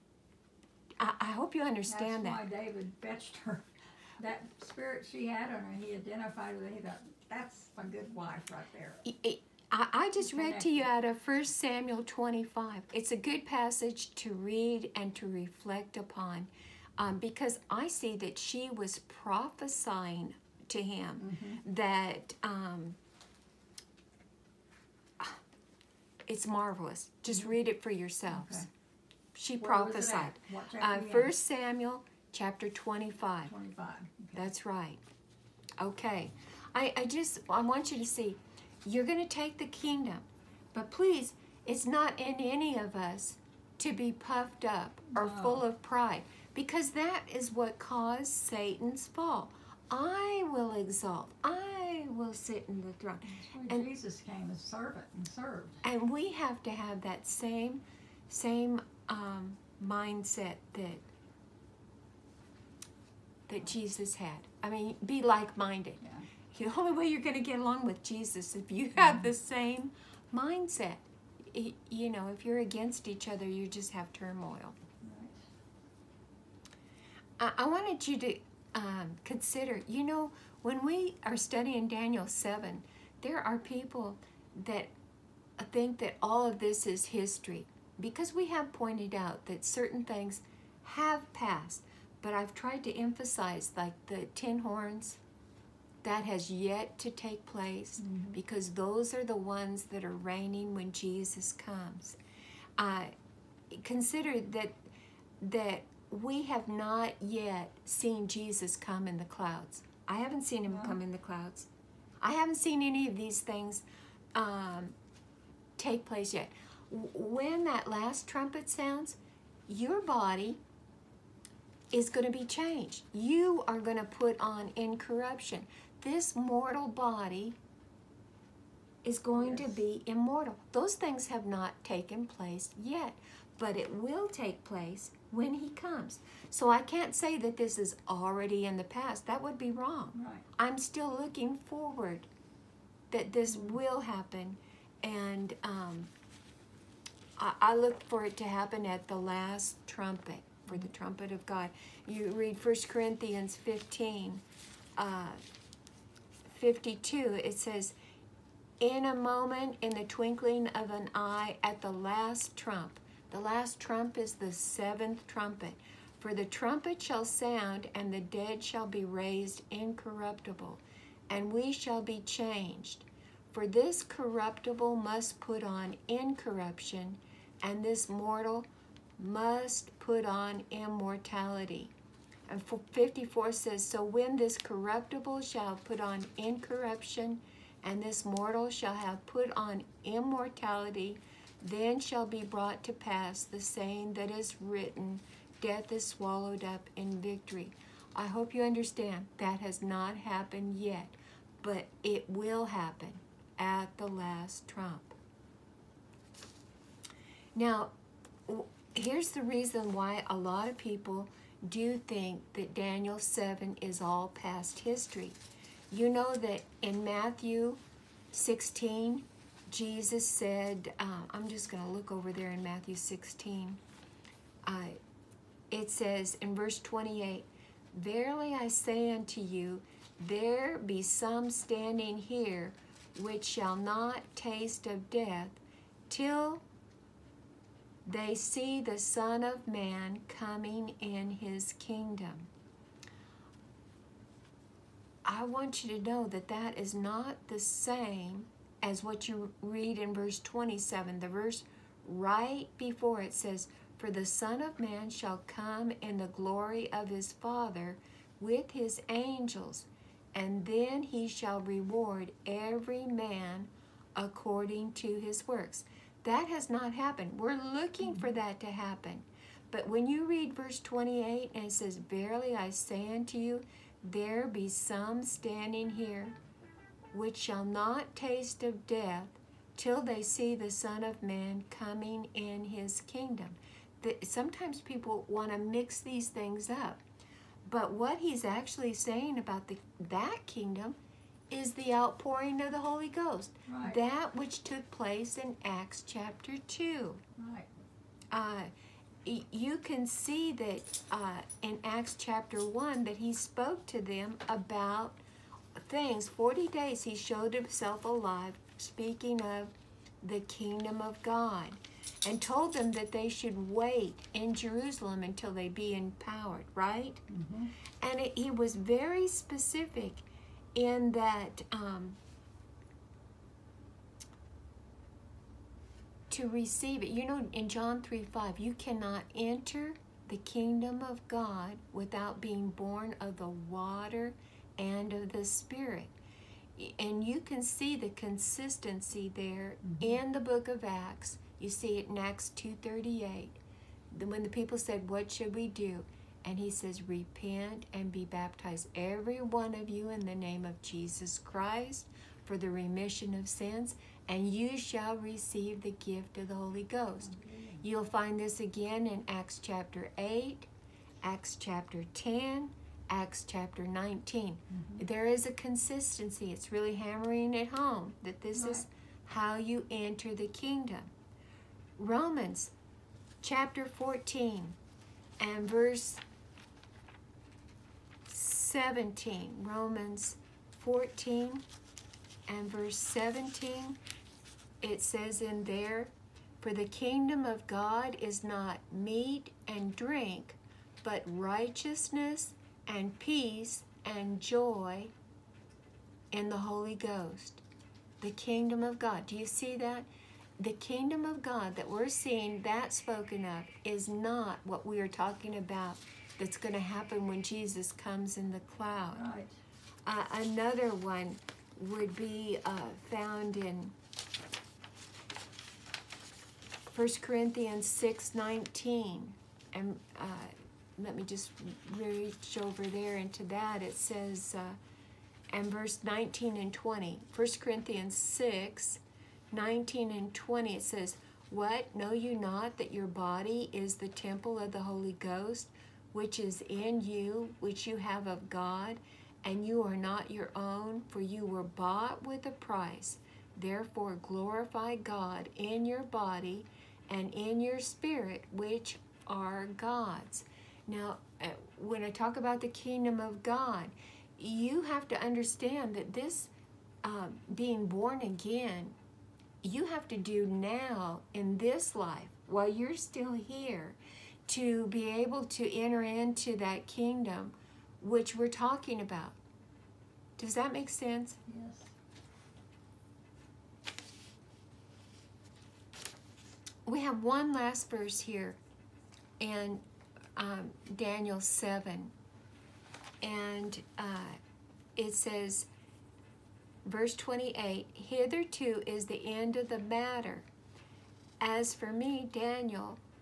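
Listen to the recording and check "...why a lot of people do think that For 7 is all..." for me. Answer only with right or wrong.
wrong.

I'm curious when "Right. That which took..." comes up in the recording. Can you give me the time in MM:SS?
04:53.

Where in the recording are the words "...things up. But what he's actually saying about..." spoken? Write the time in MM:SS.
04:46.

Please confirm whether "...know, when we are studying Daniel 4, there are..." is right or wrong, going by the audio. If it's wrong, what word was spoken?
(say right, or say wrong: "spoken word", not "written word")
wrong: "7", not "4".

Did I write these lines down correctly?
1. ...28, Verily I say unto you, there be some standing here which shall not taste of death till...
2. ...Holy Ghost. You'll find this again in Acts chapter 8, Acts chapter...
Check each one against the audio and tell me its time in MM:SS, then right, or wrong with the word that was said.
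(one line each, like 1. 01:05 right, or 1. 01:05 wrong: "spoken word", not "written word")
1. 03:46 right
2. 05:56 right.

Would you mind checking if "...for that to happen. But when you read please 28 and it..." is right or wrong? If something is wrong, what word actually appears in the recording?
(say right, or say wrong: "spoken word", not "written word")
wrong: "verse", not "please".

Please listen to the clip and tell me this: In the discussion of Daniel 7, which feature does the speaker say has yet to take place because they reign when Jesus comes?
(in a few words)
The ten horns.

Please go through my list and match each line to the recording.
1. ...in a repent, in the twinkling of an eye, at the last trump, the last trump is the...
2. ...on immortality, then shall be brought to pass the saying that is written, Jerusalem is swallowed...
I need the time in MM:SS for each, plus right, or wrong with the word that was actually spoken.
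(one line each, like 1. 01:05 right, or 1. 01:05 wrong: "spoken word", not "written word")
1. 02:38 wrong: "moment", not "repent"
2. 03:09 wrong: "Death", not "Jerusalem".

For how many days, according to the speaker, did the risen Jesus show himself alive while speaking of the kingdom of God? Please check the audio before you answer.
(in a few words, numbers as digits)
40.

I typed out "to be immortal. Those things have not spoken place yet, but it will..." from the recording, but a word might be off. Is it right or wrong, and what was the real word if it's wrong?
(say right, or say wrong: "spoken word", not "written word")
wrong: "taken", not "spoken".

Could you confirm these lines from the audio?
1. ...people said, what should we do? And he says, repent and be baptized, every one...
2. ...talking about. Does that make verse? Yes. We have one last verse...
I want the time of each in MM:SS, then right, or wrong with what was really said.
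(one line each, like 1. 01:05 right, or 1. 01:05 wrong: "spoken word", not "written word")
1. 05:44 right
2. 07:48 wrong: "sense", not "verse".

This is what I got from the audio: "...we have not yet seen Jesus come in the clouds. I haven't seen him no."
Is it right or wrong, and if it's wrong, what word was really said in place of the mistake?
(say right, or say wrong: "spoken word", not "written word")
right.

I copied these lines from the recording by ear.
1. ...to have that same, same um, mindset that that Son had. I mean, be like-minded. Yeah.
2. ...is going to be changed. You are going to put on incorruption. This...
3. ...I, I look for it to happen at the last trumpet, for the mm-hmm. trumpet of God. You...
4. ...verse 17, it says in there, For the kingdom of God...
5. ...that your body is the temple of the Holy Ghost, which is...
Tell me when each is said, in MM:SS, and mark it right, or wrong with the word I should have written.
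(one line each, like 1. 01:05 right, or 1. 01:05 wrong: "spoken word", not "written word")
1. 00:56 wrong: "Jesus", not "Son"
2. 02:01 right
3. 02:27 right
4. 06:22 right
5. 07:12 right.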